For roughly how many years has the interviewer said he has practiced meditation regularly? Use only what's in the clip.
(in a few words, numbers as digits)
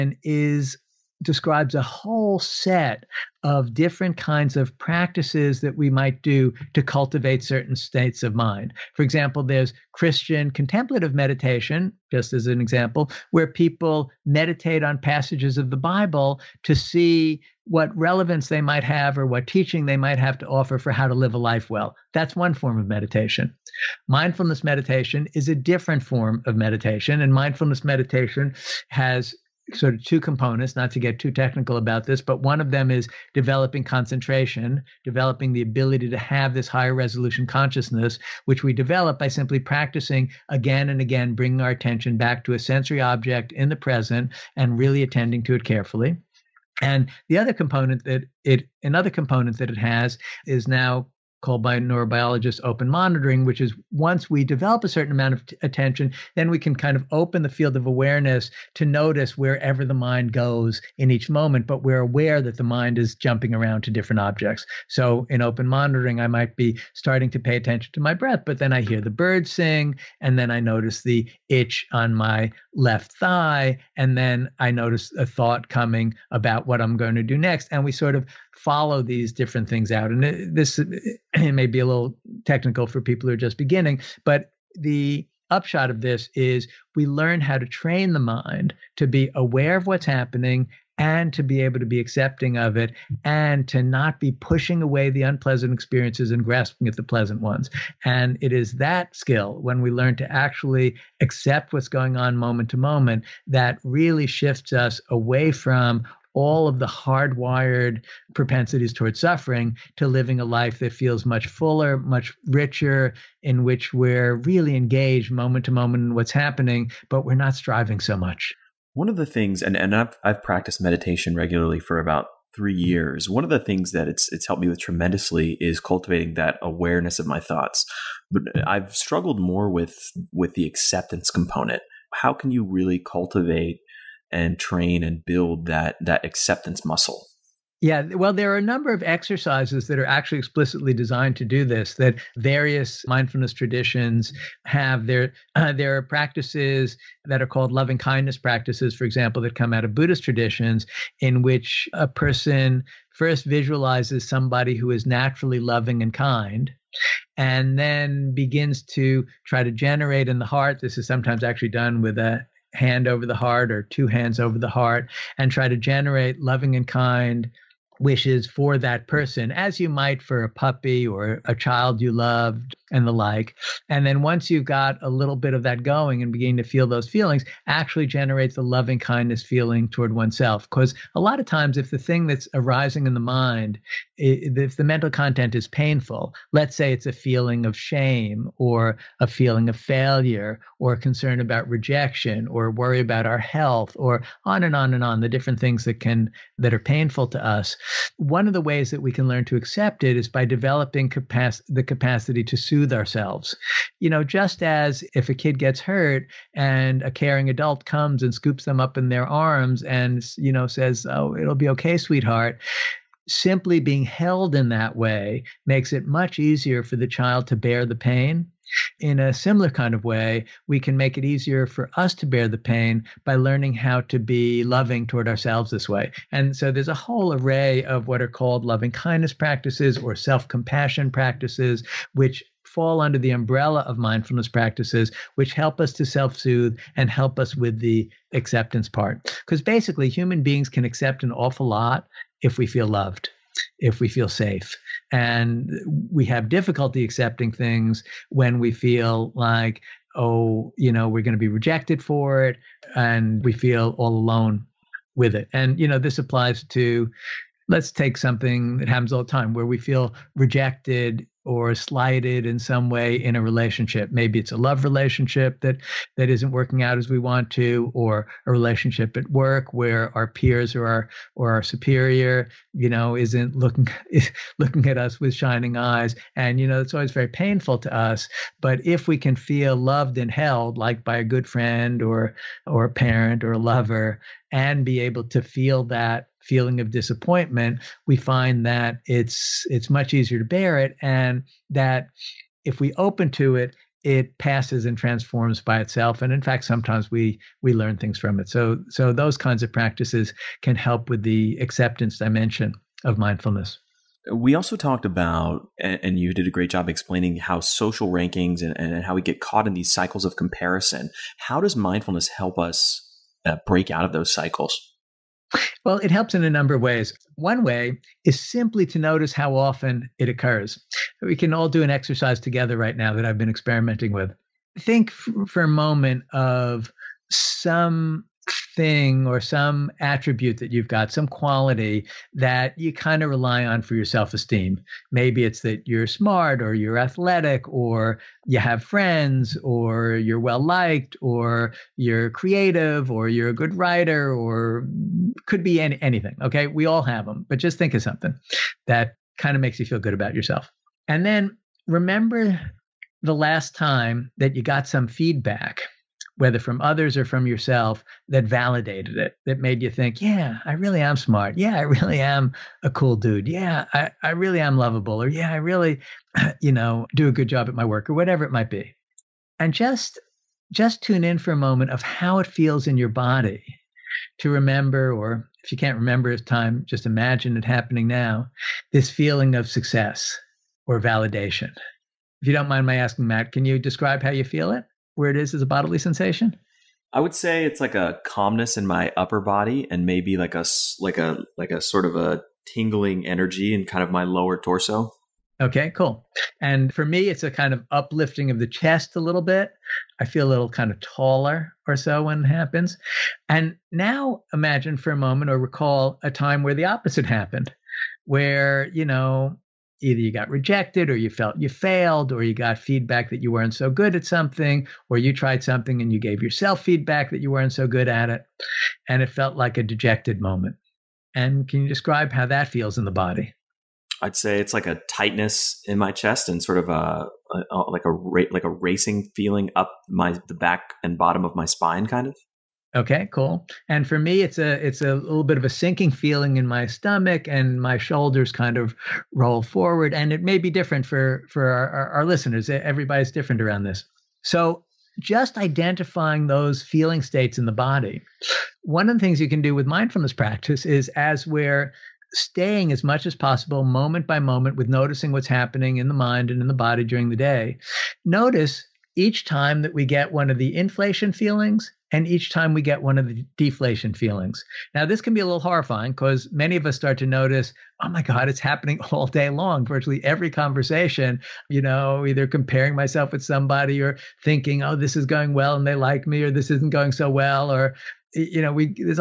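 3.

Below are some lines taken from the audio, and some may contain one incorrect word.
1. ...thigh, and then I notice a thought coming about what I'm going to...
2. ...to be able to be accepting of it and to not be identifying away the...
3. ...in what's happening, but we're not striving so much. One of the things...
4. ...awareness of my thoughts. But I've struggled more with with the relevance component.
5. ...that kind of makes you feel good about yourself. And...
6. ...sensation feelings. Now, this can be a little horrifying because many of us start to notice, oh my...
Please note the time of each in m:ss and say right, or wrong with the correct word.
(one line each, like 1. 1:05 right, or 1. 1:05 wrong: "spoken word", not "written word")
1. 1:13 right
2. 1:31 wrong: "pushing", not "identifying"
3. 1:56 right
4. 2:06 wrong: "acceptance", not "relevance"
5. 5:48 right
6. 7:43 wrong: "deflation", not "sensation".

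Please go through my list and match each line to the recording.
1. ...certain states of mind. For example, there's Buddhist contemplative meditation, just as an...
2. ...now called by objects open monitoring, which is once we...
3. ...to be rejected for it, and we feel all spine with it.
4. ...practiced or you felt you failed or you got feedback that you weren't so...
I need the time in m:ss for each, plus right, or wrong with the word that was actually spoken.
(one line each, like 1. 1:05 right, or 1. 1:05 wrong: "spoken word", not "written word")
1. 0:07 wrong: "Christian", not "Buddhist"
2. 0:50 wrong: "neurobiologists", not "objects"
3. 4:11 wrong: "alone", not "spine"
4. 6:50 wrong: "rejected", not "practiced".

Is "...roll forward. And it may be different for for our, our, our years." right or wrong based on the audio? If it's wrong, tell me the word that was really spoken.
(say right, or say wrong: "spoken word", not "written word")
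wrong: "listeners", not "years".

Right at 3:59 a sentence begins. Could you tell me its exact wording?
Because basically, human beings can accept an awful lot if we feel loved, if we feel safe.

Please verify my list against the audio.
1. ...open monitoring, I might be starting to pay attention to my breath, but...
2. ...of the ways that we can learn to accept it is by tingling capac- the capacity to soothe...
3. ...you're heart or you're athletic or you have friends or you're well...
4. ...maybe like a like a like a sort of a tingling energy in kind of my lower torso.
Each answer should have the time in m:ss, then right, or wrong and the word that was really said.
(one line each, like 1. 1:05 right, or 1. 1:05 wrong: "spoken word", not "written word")
1. 1:05 right
2. 3:18 wrong: "developing", not "tingling"
3. 5:35 wrong: "smart", not "heart"
4. 6:30 right.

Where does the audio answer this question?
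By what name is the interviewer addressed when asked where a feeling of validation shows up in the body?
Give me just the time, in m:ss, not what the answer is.
6:23.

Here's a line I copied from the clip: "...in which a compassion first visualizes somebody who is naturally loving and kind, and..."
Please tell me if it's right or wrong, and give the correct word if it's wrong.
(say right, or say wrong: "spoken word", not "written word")
wrong: "person", not "compassion".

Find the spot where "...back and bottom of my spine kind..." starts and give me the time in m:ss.
7:10.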